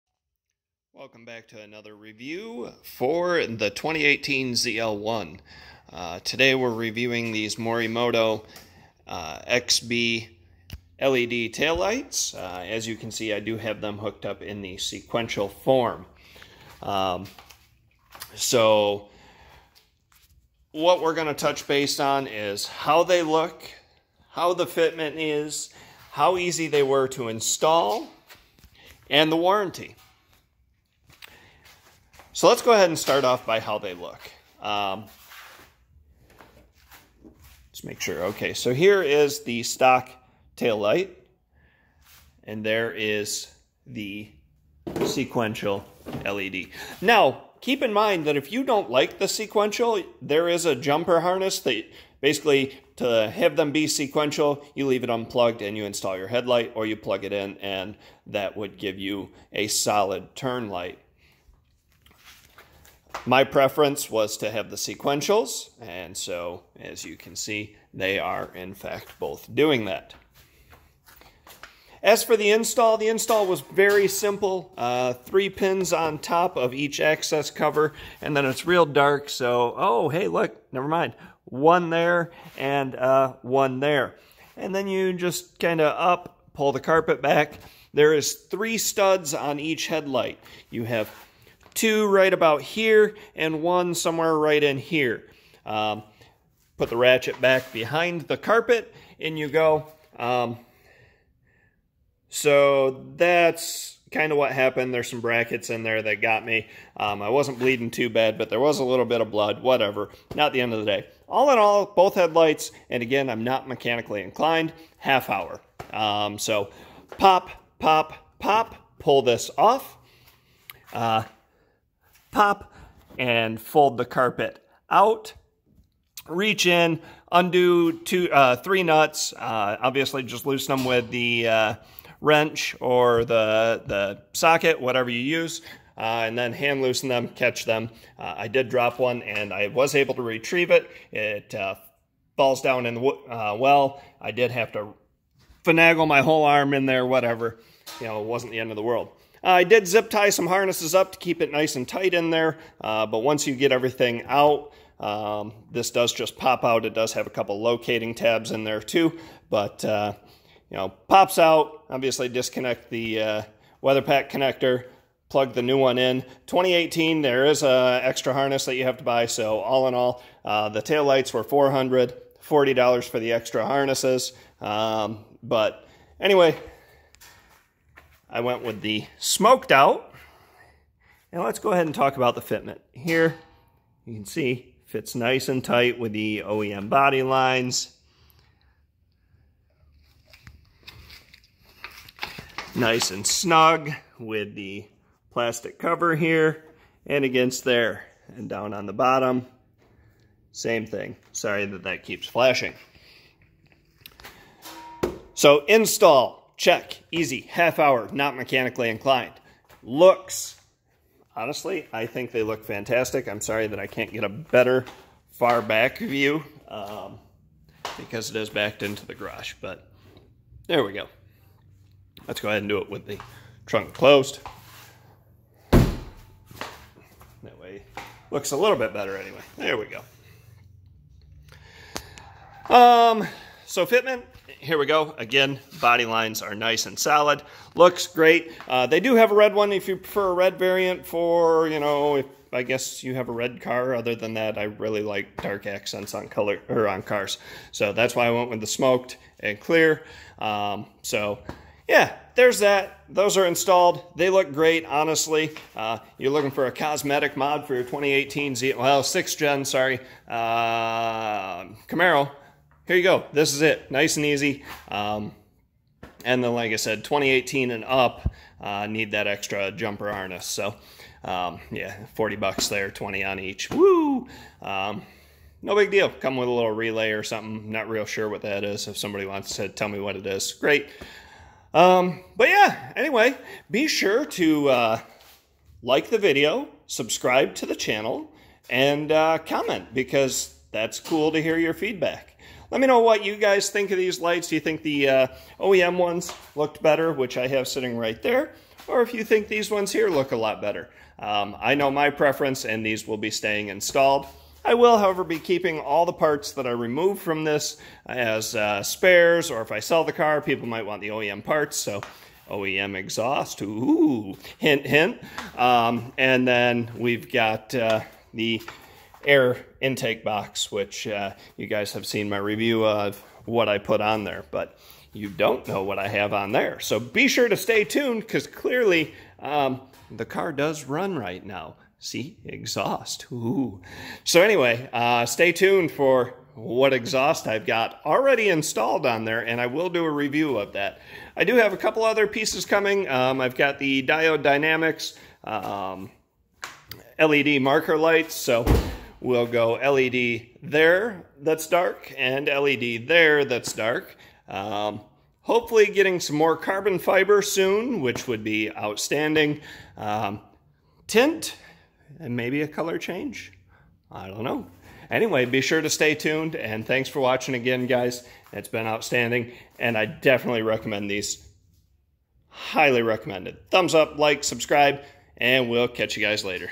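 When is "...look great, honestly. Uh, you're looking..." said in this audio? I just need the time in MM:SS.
04:14.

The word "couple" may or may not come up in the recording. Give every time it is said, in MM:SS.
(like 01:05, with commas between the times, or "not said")
02:37, 05:41.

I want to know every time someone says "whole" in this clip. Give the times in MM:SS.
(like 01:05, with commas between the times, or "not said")
02:26.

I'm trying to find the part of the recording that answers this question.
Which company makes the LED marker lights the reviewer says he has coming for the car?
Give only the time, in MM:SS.
05:44.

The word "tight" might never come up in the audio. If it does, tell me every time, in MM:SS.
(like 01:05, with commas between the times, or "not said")
02:31, 03:05.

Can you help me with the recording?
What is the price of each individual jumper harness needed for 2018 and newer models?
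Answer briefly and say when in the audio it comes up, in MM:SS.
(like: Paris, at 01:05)
$20, at 04:32.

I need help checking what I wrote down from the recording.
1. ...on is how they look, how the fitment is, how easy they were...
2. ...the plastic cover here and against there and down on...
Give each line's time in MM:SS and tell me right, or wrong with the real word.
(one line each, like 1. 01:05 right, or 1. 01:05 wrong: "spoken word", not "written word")
1. 00:22 right
2. 03:14 right.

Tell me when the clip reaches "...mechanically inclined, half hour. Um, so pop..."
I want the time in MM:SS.
01:53.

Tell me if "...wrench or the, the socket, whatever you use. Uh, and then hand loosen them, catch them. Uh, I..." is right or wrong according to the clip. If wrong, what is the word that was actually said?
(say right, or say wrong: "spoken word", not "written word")
right.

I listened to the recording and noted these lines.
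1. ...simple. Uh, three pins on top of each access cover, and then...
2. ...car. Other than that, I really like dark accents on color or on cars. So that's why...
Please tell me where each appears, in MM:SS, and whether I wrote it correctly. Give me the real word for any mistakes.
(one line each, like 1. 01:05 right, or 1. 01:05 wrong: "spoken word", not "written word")
1. 01:14 right
2. 04:03 right.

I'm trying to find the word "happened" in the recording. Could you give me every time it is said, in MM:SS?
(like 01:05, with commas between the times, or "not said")
01:44.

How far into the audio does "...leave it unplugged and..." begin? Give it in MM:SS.
00:54.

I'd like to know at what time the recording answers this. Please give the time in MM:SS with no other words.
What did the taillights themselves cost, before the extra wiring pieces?
02:51.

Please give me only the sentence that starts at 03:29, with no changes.
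Looks, honestly, I think they look fantastic.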